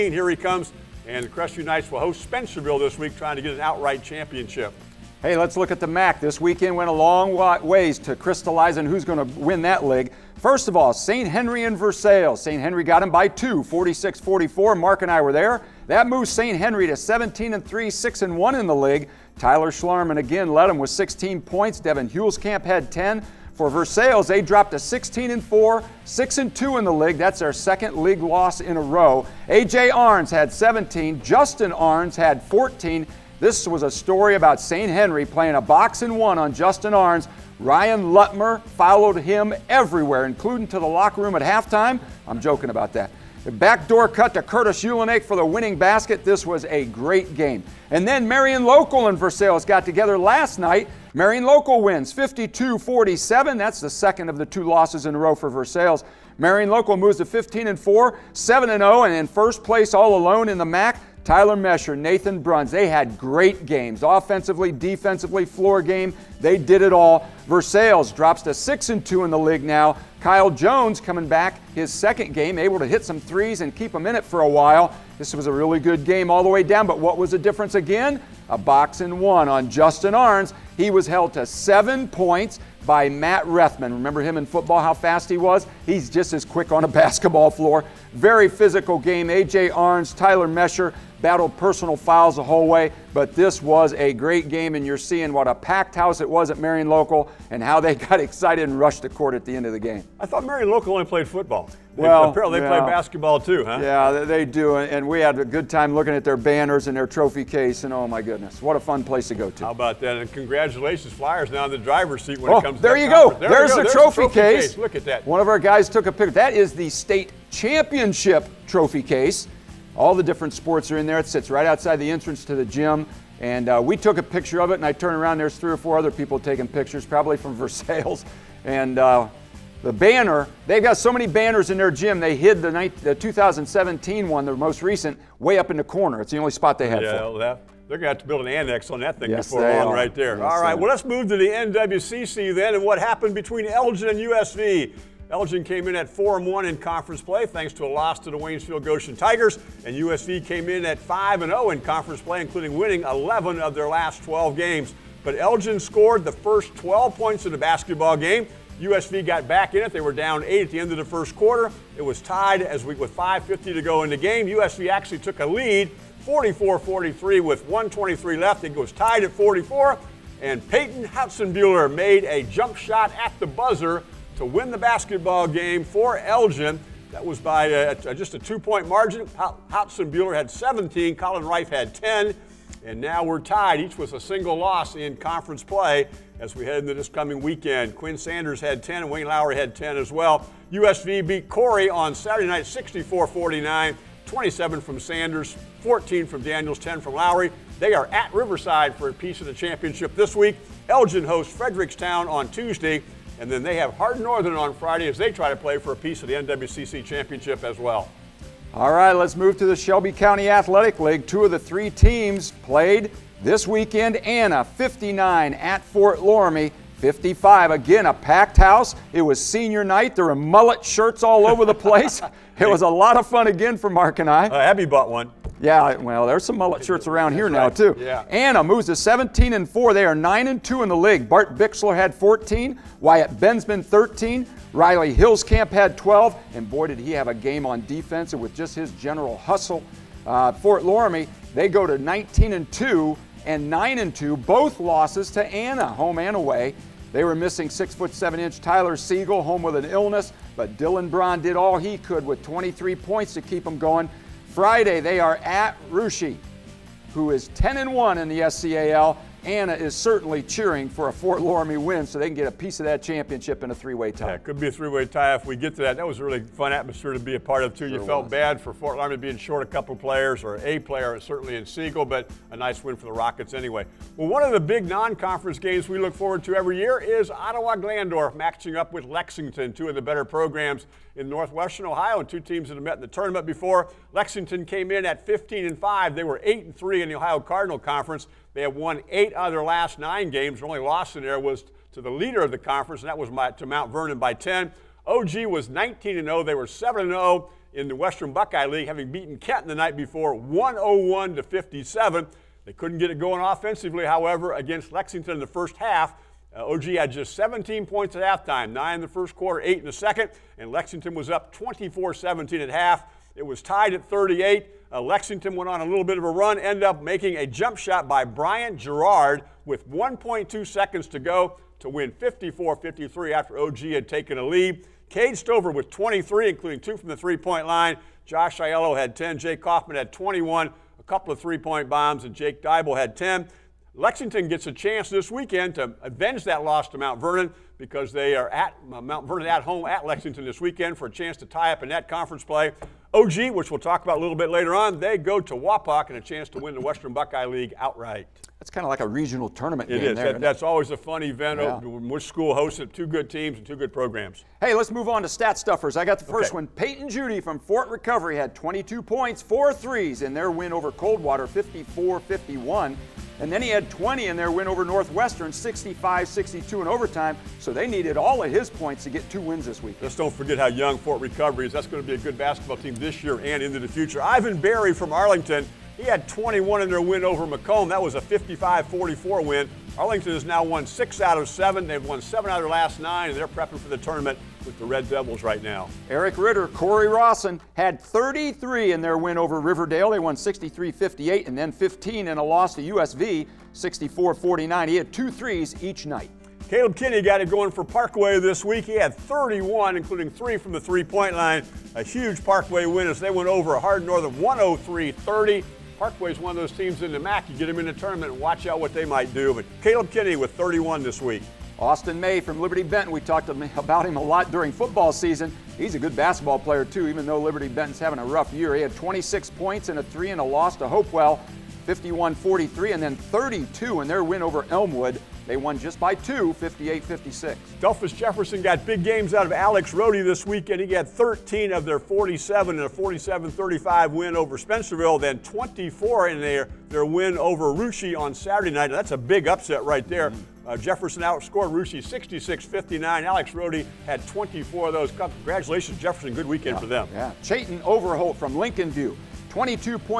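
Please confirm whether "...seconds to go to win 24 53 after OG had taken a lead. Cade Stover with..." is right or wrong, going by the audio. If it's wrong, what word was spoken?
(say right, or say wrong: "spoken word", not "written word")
wrong: "54", not "24".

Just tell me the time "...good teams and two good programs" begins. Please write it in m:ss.
5:53.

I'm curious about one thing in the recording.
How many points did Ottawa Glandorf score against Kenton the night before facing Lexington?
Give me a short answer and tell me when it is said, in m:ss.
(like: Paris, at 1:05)
101, at 5:00.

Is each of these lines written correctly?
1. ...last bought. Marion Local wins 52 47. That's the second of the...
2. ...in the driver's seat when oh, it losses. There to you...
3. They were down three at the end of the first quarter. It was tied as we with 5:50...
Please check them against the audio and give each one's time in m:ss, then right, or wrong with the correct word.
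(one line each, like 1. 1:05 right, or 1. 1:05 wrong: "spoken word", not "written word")
1. 0:50 wrong: "night", not "bought"
2. 1:51 wrong: "comes", not "losses"
3. 2:39 wrong: "eight", not "three".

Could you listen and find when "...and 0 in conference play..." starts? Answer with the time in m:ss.
2:31.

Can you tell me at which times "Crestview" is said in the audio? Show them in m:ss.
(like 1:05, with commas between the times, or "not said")
0:01.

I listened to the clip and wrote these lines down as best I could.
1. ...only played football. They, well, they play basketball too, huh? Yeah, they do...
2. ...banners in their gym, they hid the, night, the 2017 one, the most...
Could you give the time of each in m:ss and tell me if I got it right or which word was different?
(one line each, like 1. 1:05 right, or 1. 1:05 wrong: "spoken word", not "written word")
1. 1:40 right
2. 2:11 right.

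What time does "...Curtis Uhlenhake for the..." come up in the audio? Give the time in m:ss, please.
0:44.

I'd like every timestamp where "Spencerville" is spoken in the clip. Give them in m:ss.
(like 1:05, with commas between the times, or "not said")
0:02, 7:14.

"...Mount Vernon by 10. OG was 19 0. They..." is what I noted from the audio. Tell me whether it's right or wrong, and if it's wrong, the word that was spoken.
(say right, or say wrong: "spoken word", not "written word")
right.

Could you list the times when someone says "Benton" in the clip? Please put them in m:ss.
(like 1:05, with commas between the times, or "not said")
6:52, 6:57.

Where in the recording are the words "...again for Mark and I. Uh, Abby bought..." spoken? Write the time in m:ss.
3:43.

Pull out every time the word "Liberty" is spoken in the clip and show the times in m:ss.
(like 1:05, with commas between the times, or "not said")
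6:52, 6:57.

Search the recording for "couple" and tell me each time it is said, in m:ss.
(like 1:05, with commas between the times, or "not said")
4:29, 5:31.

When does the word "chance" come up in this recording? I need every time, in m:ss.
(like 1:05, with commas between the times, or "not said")
5:34, 5:41, 5:46.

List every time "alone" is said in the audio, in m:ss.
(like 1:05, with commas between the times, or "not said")
1:00.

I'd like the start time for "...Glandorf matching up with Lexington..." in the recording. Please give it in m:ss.
4:37.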